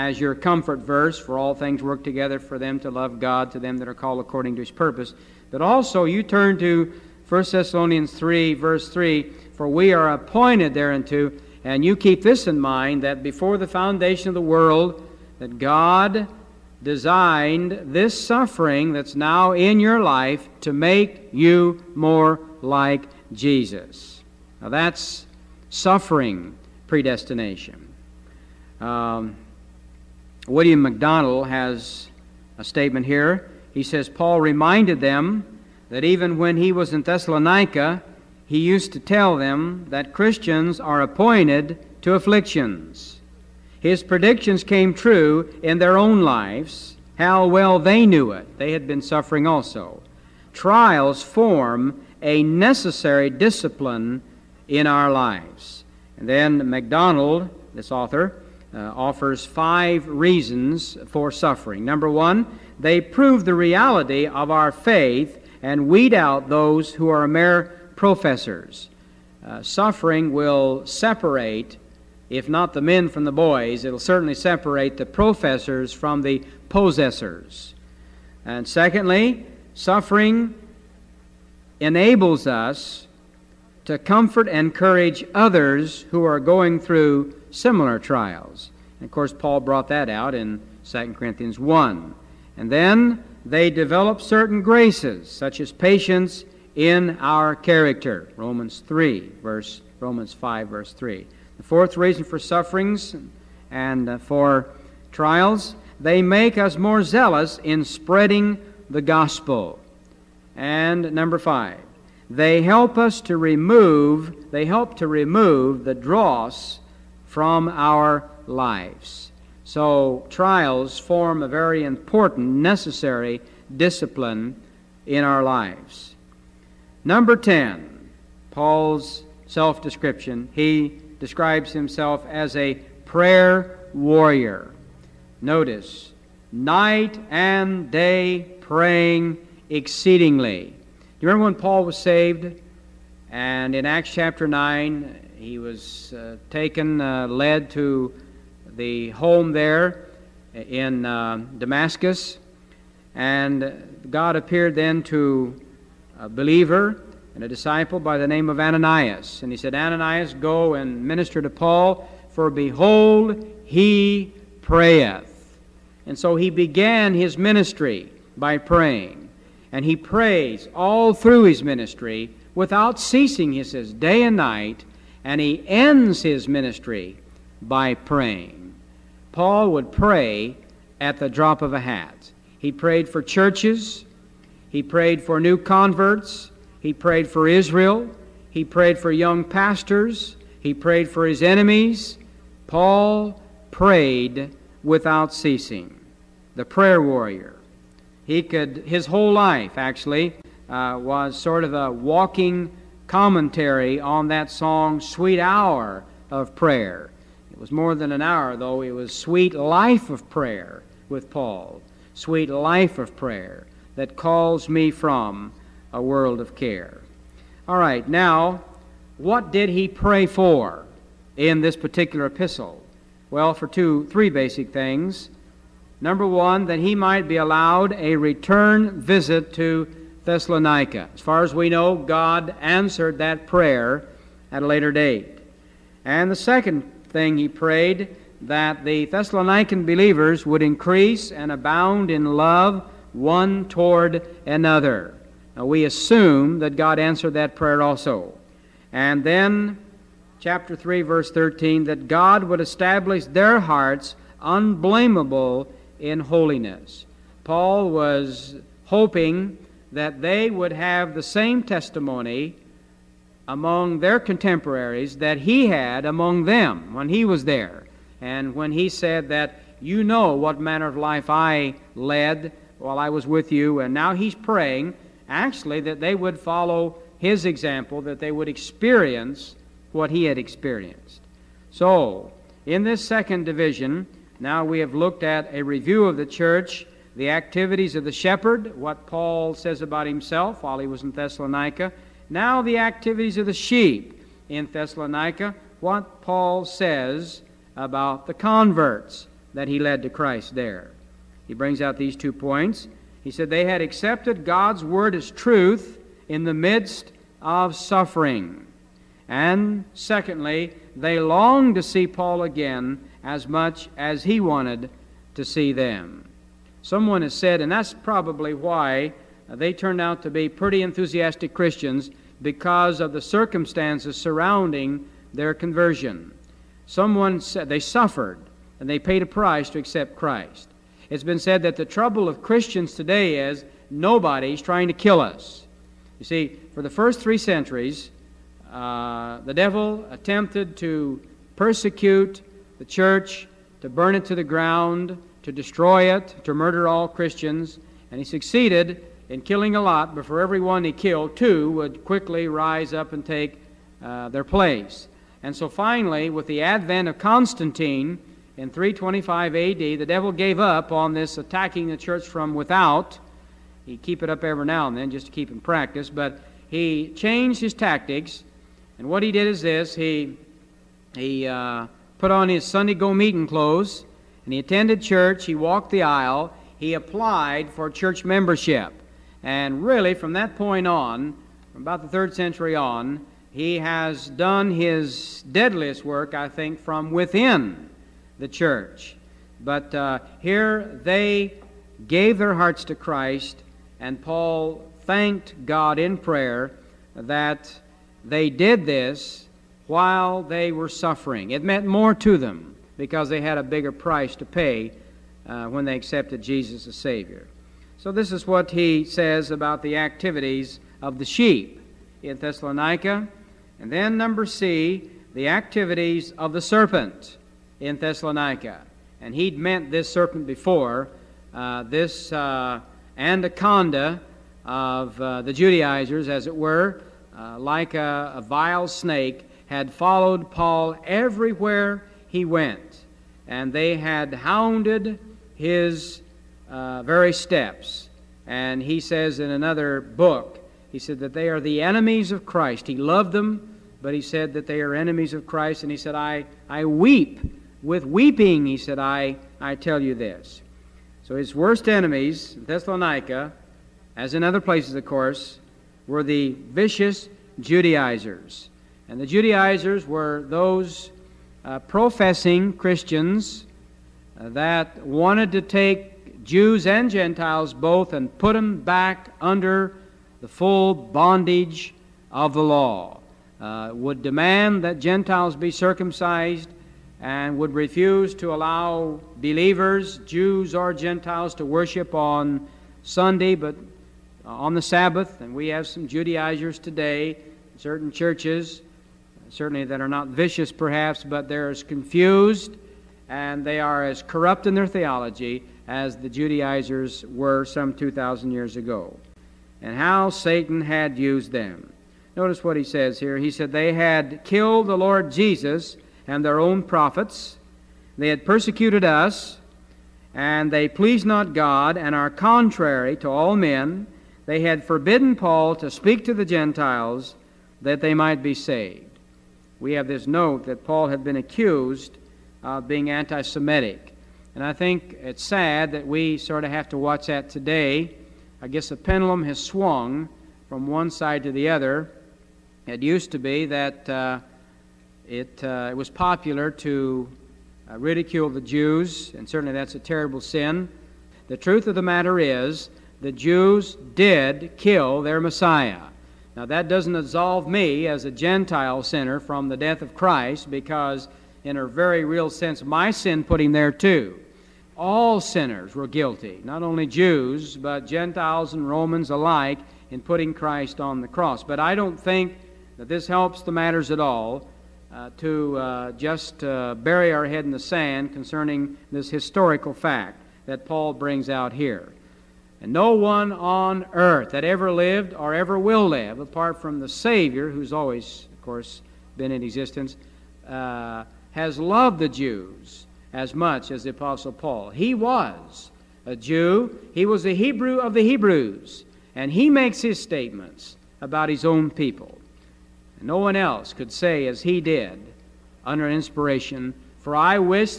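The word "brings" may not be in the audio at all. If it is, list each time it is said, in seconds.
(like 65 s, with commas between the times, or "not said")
301 s, 571 s.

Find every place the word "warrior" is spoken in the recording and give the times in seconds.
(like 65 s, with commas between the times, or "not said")
133 s, 197 s.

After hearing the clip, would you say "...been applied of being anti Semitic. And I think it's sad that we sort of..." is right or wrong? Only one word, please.
wrong.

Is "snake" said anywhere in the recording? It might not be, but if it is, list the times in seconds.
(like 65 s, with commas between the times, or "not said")
428 s.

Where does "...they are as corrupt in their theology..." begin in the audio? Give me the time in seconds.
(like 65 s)
493 s.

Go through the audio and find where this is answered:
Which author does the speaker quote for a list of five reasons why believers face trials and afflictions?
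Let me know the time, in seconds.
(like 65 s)
30 s.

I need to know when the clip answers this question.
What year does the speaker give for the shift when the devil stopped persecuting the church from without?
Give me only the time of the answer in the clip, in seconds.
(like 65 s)
358 s.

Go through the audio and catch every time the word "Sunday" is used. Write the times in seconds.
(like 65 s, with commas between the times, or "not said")
372 s, 483 s.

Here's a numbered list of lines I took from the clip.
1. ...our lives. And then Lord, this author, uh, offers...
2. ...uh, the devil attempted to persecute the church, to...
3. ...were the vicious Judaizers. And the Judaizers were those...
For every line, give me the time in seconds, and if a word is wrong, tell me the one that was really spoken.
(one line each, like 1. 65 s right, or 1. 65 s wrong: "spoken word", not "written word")
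1. 54 s wrong: "MacDonald", not "Lord"
2. 338 s right
3. 456 s right.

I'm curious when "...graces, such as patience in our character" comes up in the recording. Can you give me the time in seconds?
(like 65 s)
94 s.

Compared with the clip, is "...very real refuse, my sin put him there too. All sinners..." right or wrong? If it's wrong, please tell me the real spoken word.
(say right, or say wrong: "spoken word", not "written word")
wrong: "sense", not "refuse".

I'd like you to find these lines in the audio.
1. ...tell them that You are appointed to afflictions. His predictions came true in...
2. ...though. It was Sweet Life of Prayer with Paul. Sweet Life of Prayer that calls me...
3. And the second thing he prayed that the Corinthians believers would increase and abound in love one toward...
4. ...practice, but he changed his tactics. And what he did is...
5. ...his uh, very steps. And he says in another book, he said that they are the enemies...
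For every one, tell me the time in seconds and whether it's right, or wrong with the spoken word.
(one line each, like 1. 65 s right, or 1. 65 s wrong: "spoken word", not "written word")
1. 38 s wrong: "Christians", not "You"
2. 208 s right
3. 236 s wrong: "Thessalonican", not "Corinthians"
4. 365 s right
5. 435 s right.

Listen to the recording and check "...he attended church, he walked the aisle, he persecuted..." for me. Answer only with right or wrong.
wrong.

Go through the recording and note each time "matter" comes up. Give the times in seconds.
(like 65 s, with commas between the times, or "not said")
542 s, 563 s.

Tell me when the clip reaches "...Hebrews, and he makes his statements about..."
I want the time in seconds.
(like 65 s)
588 s.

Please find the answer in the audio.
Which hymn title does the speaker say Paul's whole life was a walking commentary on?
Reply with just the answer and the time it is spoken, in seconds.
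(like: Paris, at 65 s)
Sweet Hour of Prayer, at 204 s.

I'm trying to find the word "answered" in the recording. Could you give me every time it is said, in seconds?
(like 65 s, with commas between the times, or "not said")
232 s, 246 s.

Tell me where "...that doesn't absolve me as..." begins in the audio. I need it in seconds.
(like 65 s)
546 s.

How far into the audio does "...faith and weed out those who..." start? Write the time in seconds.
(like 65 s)
64 s.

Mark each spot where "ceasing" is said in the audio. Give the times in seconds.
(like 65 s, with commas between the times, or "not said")
172 s, 195 s.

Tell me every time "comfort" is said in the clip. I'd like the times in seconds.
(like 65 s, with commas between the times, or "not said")
0 s, 83 s.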